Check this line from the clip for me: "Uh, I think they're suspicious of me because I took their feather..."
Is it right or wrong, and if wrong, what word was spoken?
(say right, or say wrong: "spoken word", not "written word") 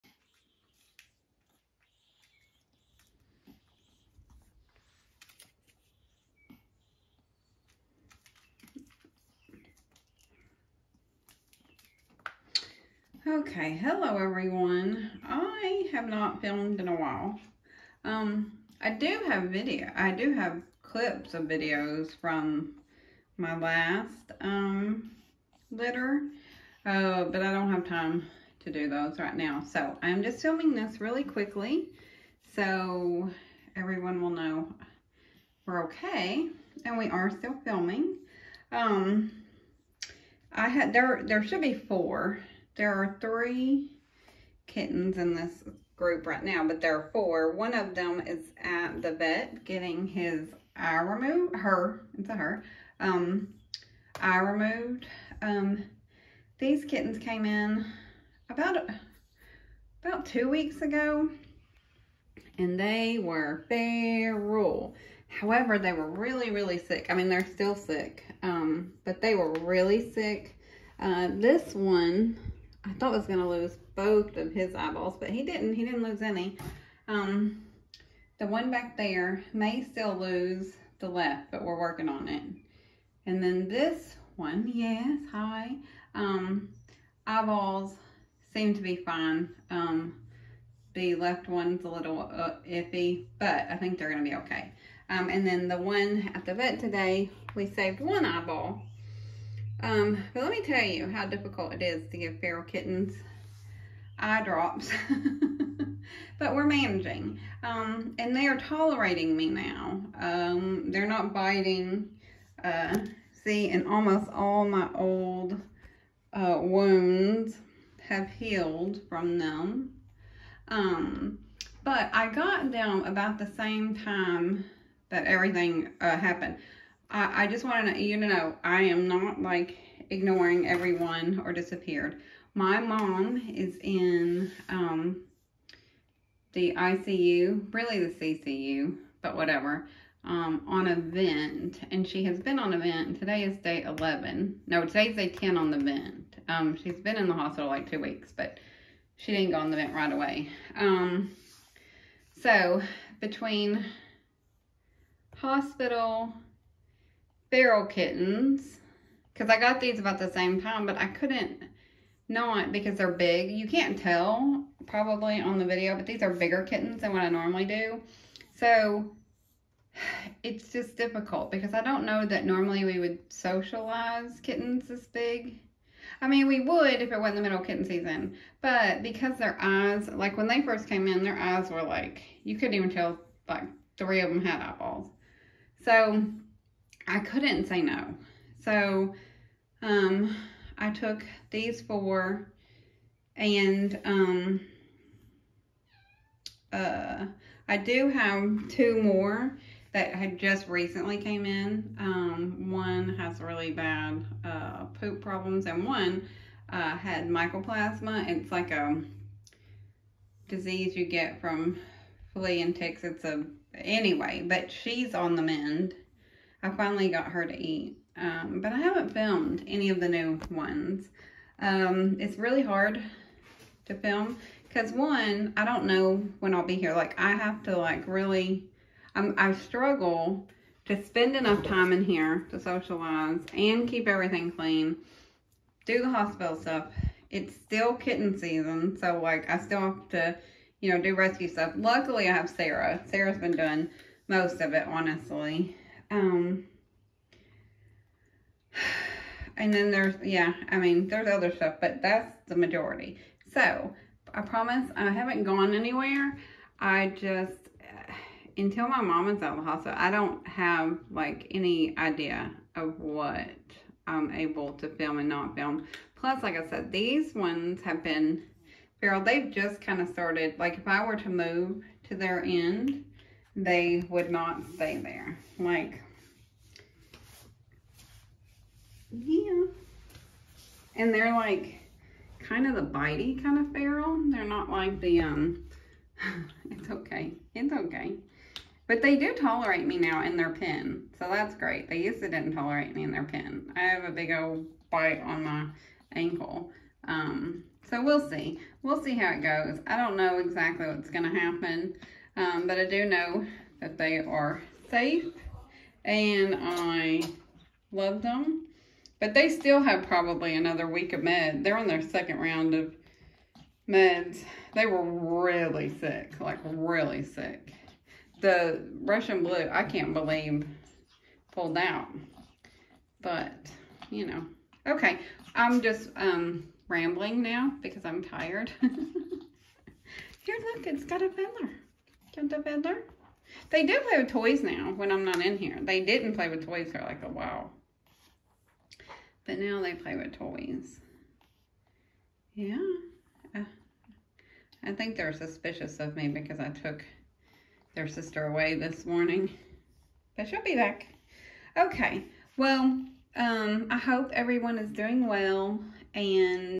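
wrong: "sister", not "feather".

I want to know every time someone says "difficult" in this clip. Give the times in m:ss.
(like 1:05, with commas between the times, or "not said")
1:41, 2:50.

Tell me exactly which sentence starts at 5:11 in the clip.
They're on their second round of meds.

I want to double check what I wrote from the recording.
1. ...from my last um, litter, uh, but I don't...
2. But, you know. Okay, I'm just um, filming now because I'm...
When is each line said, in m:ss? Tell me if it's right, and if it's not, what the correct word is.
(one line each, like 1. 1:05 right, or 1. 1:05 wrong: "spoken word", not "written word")
1. 0:22 right
2. 5:23 wrong: "rambling", not "filming".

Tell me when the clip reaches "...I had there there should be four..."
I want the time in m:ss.
0:40.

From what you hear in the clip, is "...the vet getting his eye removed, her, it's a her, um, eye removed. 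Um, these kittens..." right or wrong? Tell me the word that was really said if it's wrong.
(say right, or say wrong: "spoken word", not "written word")
right.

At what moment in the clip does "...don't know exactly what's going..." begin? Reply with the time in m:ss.
4:59.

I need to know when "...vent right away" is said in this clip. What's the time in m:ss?
2:29.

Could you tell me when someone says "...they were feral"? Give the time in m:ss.
1:02.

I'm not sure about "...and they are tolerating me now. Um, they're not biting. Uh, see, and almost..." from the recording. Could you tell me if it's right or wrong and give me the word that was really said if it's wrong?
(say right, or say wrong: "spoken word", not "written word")
right.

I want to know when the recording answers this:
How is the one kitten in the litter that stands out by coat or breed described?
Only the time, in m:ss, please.
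5:19.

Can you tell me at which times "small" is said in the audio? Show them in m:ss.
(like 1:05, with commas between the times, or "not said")
not said.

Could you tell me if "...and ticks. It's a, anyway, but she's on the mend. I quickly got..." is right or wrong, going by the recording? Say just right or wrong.
wrong.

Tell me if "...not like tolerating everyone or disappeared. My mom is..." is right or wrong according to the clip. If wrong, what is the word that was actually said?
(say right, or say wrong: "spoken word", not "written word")
wrong: "ignoring", not "tolerating".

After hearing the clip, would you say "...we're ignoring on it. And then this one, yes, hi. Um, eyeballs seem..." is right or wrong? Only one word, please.
wrong.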